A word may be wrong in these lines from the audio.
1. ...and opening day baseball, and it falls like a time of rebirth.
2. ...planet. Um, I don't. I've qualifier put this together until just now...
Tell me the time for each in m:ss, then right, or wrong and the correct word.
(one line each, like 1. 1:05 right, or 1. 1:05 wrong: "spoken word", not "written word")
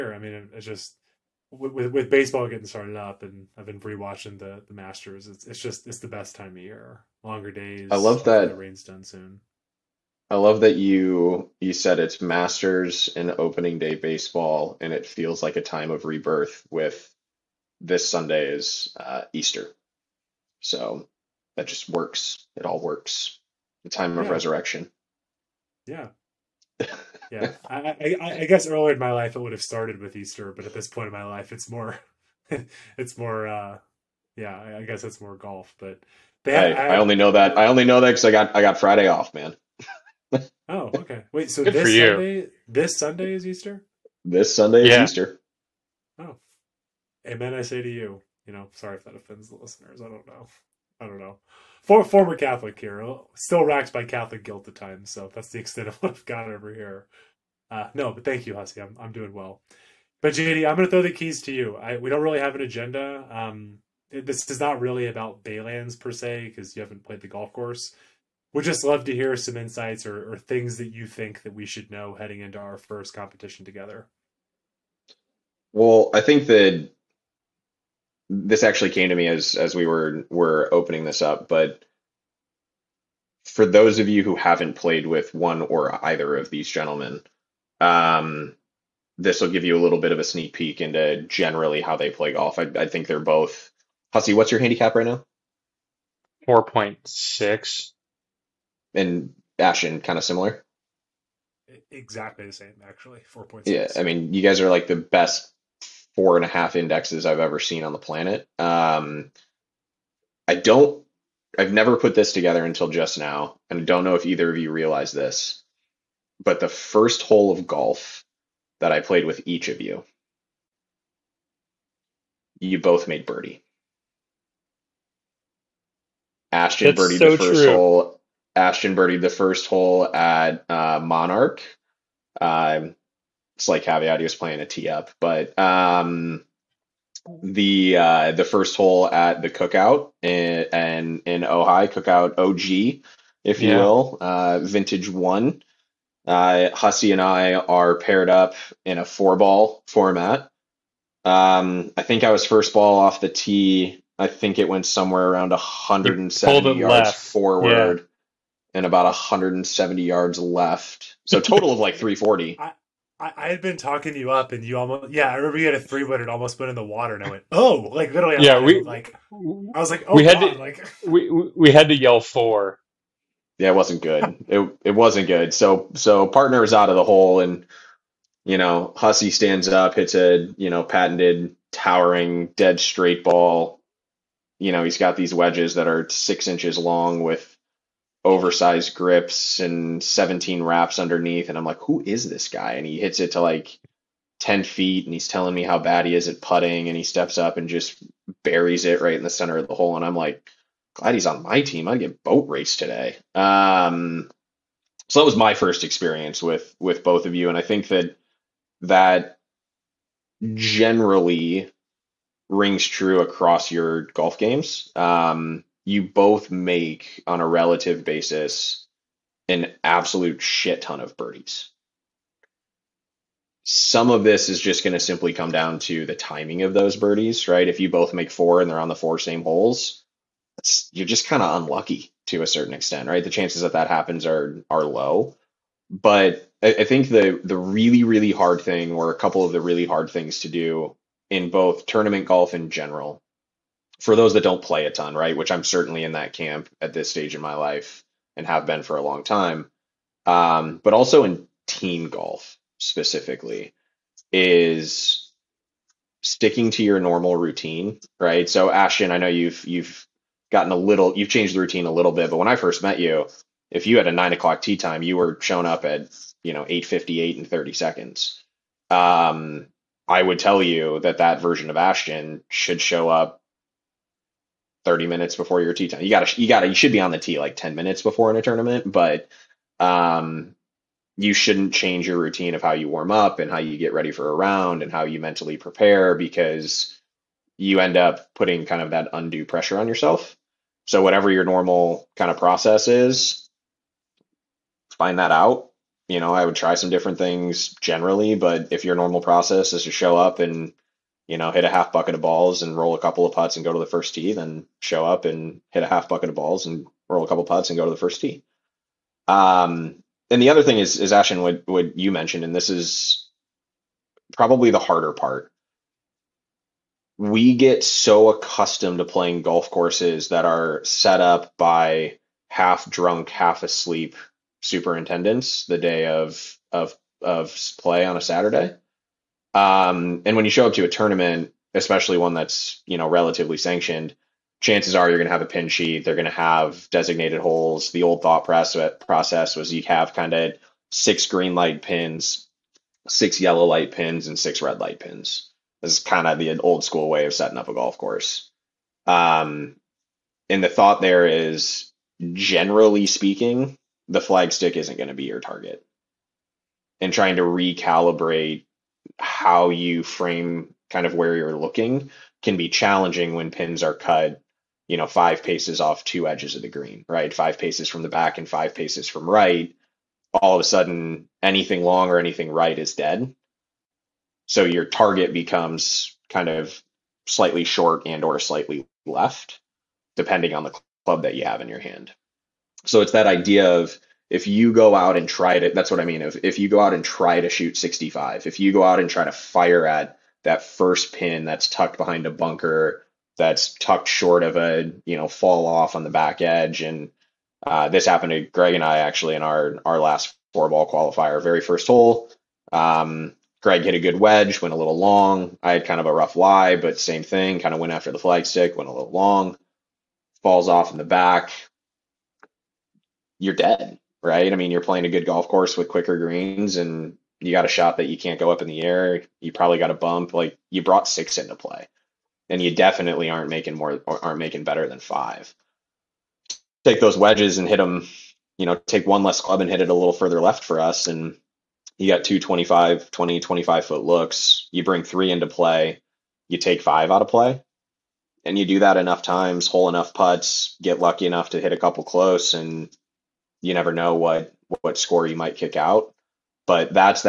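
1. 0:13 wrong: "feels", not "falls"
2. 1:47 wrong: "never", not "qualifier".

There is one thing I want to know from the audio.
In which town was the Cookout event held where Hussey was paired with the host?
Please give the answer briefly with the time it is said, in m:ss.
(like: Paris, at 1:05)
Ojai, at 2:21.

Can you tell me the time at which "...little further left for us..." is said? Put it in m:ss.
7:09.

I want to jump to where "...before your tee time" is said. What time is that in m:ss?
4:35.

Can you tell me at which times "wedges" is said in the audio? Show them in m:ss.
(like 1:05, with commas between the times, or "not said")
3:05, 6:44, 7:07.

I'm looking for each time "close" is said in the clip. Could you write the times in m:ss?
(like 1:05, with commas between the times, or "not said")
7:22.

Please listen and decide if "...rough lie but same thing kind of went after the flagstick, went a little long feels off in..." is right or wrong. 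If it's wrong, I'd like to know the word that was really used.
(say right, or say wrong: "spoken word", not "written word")
wrong: "falls", not "feels".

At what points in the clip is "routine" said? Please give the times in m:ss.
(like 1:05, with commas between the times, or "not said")
4:17, 4:21, 4:42.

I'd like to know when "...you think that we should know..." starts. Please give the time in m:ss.
1:10.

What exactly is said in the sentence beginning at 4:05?
Which I'm certainly in that camp at this stage in my life and have been for a long time.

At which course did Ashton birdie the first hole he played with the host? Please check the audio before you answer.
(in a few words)
Monarch.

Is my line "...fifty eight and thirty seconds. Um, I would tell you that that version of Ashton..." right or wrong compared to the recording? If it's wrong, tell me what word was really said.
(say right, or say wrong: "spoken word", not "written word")
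right.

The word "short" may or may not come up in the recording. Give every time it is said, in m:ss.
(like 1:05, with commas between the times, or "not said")
6:17, 6:34.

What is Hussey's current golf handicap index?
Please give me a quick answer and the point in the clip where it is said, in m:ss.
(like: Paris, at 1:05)
4.6, at 1:36.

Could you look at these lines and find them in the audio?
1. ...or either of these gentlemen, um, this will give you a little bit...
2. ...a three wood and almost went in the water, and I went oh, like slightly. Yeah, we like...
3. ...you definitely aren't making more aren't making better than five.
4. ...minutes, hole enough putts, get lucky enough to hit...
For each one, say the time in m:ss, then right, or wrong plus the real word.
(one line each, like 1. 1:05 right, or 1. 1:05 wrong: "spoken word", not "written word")
1. 1:25 right
2. 2:45 wrong: "literally", not "slightly"
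3. 7:02 right
4. 7:19 wrong: "times", not "minutes".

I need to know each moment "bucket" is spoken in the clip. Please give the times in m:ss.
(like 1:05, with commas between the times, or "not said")
5:01, 5:06.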